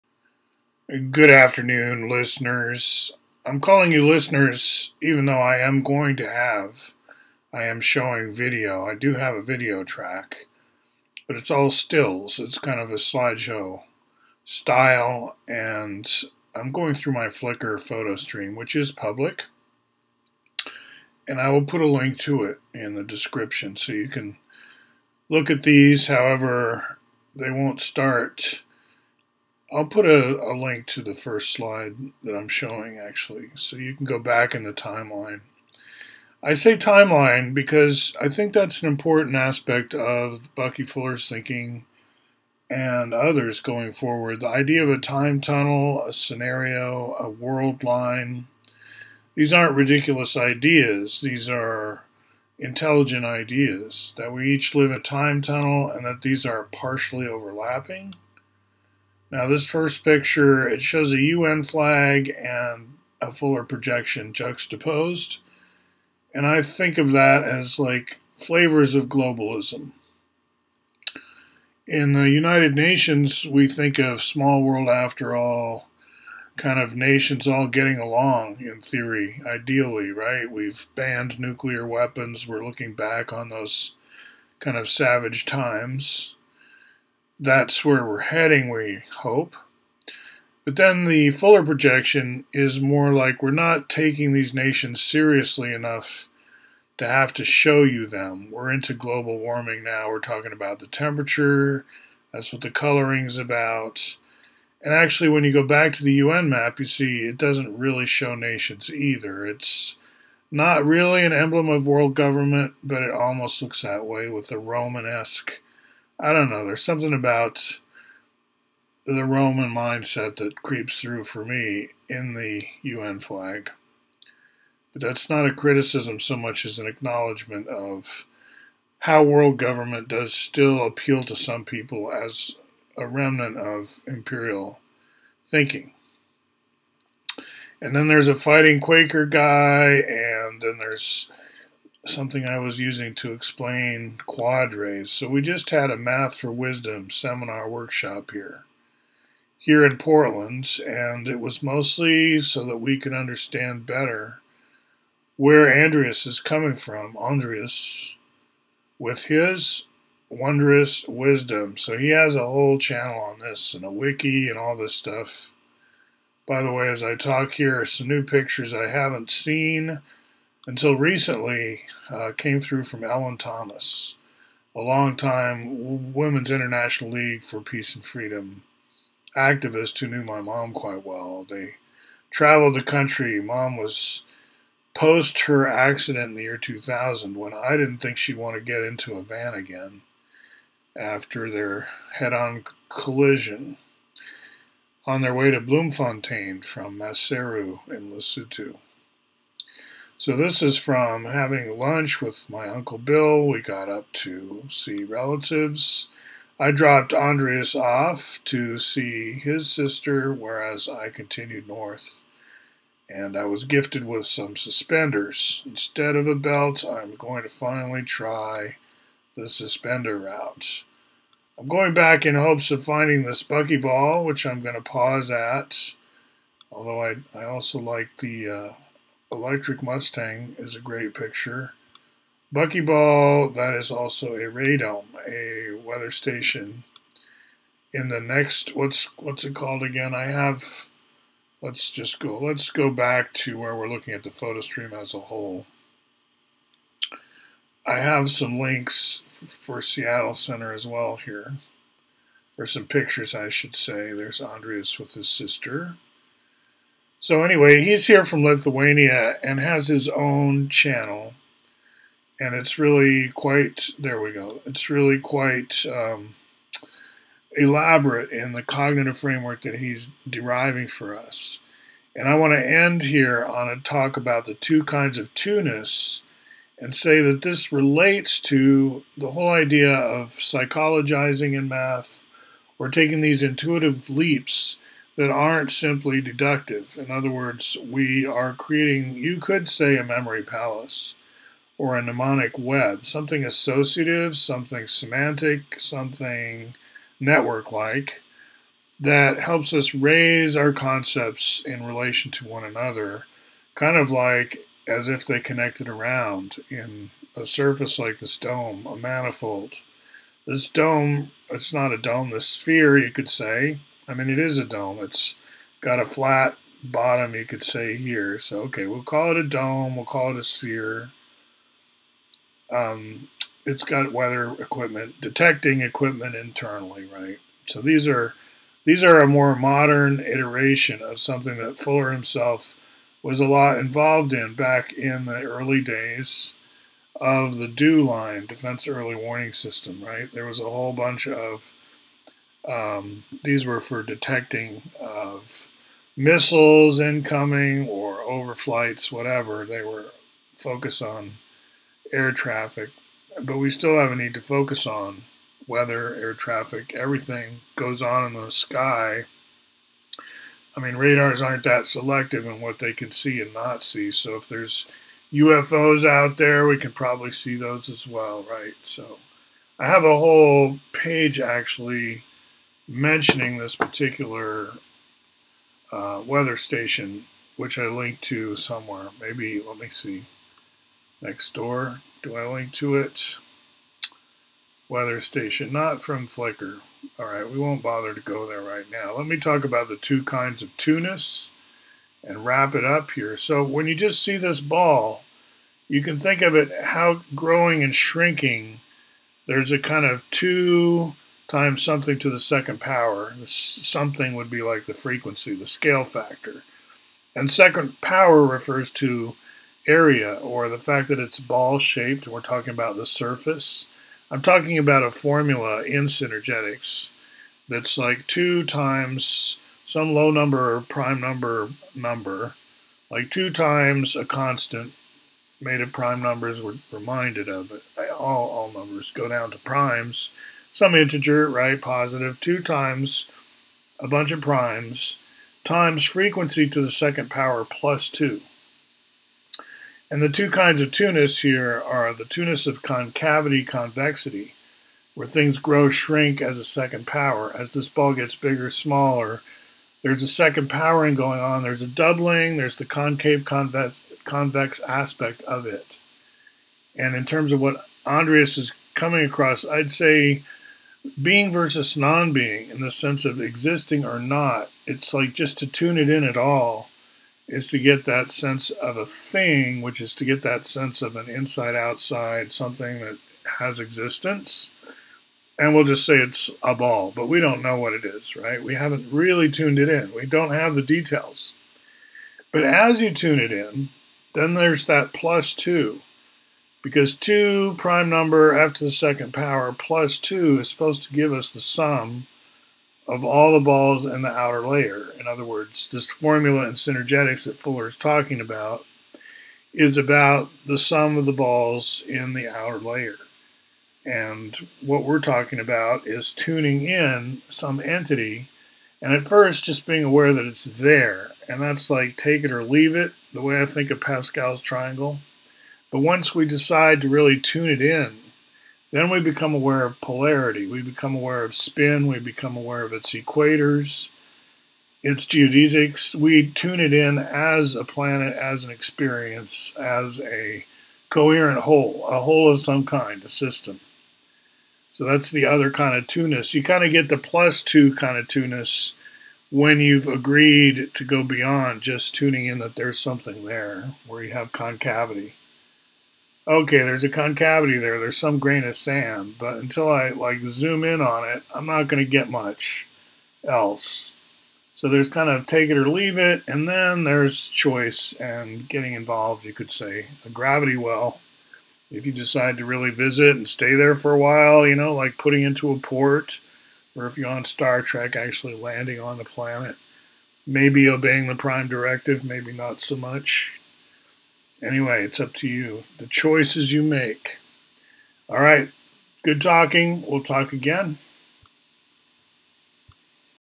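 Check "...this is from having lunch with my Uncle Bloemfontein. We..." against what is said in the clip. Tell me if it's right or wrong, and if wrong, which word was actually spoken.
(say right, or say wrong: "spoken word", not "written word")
wrong: "Bill", not "Bloemfontein".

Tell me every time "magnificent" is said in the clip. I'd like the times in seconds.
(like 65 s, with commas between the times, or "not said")
not said.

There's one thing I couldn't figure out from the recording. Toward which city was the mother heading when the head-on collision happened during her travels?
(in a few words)
Bloemfontein.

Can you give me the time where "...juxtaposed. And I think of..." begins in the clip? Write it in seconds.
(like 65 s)
64 s.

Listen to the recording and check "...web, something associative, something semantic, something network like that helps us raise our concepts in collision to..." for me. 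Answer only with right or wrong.
wrong.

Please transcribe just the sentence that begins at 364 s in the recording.
So if there's UFOs out there, we can probably see those as well, right?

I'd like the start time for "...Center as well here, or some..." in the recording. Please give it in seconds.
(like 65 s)
250 s.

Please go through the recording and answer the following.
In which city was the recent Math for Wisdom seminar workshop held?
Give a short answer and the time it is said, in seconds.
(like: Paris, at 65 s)
Portland, at 149 s.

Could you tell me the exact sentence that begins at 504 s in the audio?
And what we're talking about is tuning in some entity and at first just being aware that it's there.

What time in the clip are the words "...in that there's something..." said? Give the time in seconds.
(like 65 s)
542 s.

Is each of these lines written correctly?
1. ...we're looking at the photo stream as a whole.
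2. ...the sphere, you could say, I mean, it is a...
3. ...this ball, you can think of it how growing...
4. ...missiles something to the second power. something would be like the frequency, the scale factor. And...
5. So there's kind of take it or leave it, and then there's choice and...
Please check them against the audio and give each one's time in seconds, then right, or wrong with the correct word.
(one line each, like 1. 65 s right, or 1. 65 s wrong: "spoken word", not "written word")
1. 243 s right
2. 312 s right
3. 394 s right
4. 401 s wrong: "times", not "missiles"
5. 554 s right.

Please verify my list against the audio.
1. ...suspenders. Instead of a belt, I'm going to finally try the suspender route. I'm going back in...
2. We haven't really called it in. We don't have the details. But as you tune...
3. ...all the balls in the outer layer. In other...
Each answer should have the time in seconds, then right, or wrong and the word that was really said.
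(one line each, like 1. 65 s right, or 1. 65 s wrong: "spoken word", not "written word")
1. 214 s right
2. 478 s wrong: "tuned", not "called"
3. 493 s right.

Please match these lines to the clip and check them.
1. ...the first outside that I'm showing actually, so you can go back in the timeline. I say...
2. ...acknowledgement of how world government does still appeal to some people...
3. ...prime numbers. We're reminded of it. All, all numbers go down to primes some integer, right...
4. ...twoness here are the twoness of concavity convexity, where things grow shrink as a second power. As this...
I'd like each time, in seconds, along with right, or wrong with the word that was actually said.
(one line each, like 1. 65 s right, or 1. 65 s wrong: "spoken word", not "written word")
1. 31 s wrong: "slide", not "outside"
2. 126 s right
3. 425 s right
4. 440 s right.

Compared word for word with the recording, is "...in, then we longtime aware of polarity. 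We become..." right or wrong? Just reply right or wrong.
wrong.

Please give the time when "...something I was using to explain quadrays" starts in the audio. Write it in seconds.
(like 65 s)
142 s.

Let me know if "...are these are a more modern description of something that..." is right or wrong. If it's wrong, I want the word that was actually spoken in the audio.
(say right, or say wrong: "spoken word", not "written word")
wrong: "iteration", not "description".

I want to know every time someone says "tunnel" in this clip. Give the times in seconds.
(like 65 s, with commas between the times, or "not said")
45 s, 55 s.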